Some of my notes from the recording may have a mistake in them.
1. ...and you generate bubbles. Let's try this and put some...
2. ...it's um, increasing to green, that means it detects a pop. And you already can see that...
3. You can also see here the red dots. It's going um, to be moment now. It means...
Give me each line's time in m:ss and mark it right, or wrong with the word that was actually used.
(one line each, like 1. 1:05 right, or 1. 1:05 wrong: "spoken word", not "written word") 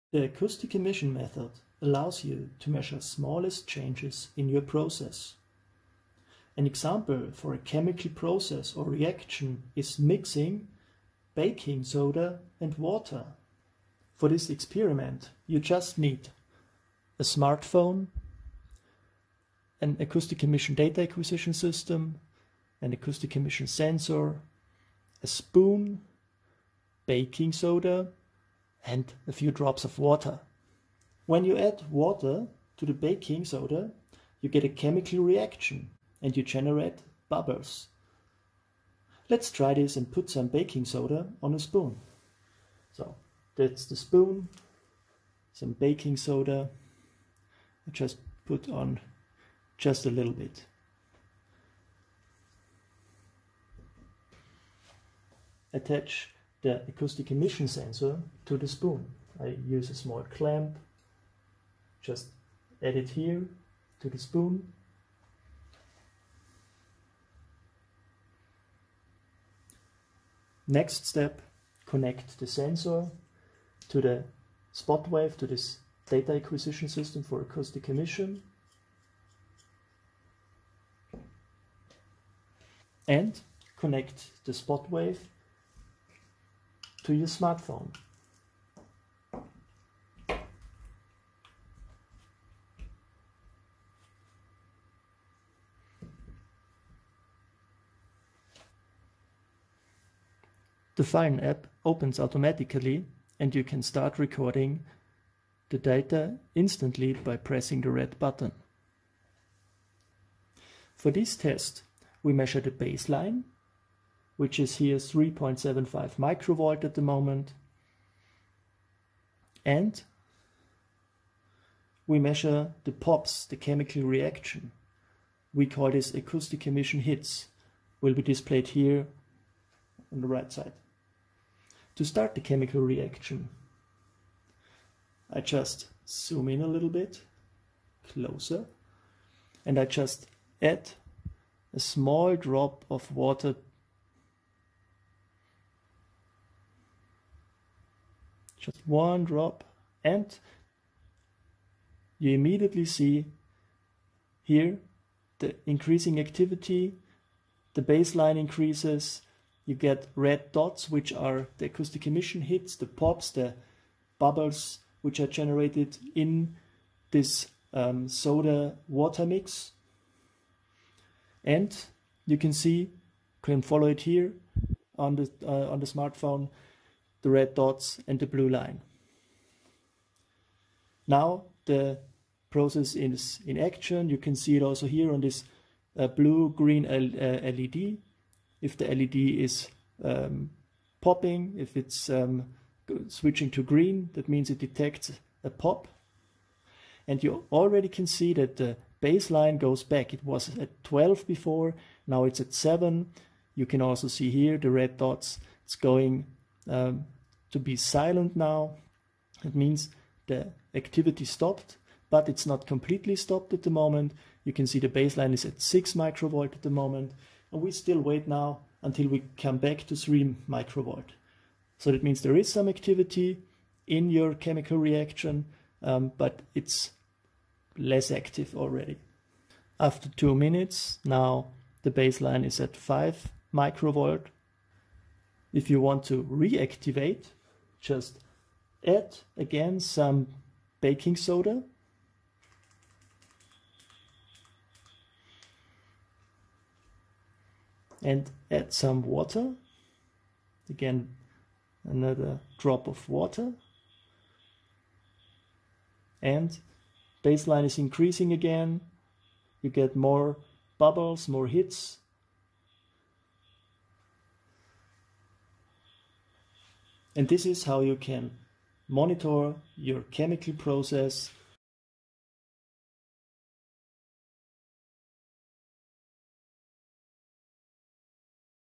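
1. 0:36 right
2. 3:11 wrong: "switching", not "increasing"
3. 3:23 wrong: "silent", not "moment".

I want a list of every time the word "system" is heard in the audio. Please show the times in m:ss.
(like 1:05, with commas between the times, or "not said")
0:21, 1:16.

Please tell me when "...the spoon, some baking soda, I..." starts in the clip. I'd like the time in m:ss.
0:43.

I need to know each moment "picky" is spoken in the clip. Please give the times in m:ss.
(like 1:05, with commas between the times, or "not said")
not said.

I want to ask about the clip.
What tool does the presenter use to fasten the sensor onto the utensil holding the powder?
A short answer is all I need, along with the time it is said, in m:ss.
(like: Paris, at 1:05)
small clamp, at 0:59.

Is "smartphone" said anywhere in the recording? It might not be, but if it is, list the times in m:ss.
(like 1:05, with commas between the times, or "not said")
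0:17, 1:27, 2:55.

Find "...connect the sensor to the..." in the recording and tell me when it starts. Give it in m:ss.
1:11.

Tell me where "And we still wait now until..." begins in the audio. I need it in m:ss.
3:37.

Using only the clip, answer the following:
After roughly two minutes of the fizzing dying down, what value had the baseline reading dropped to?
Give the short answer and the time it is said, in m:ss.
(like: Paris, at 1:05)
5 microvolts, at 3:52.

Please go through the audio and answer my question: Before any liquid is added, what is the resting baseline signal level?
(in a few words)
3.75 microvolts.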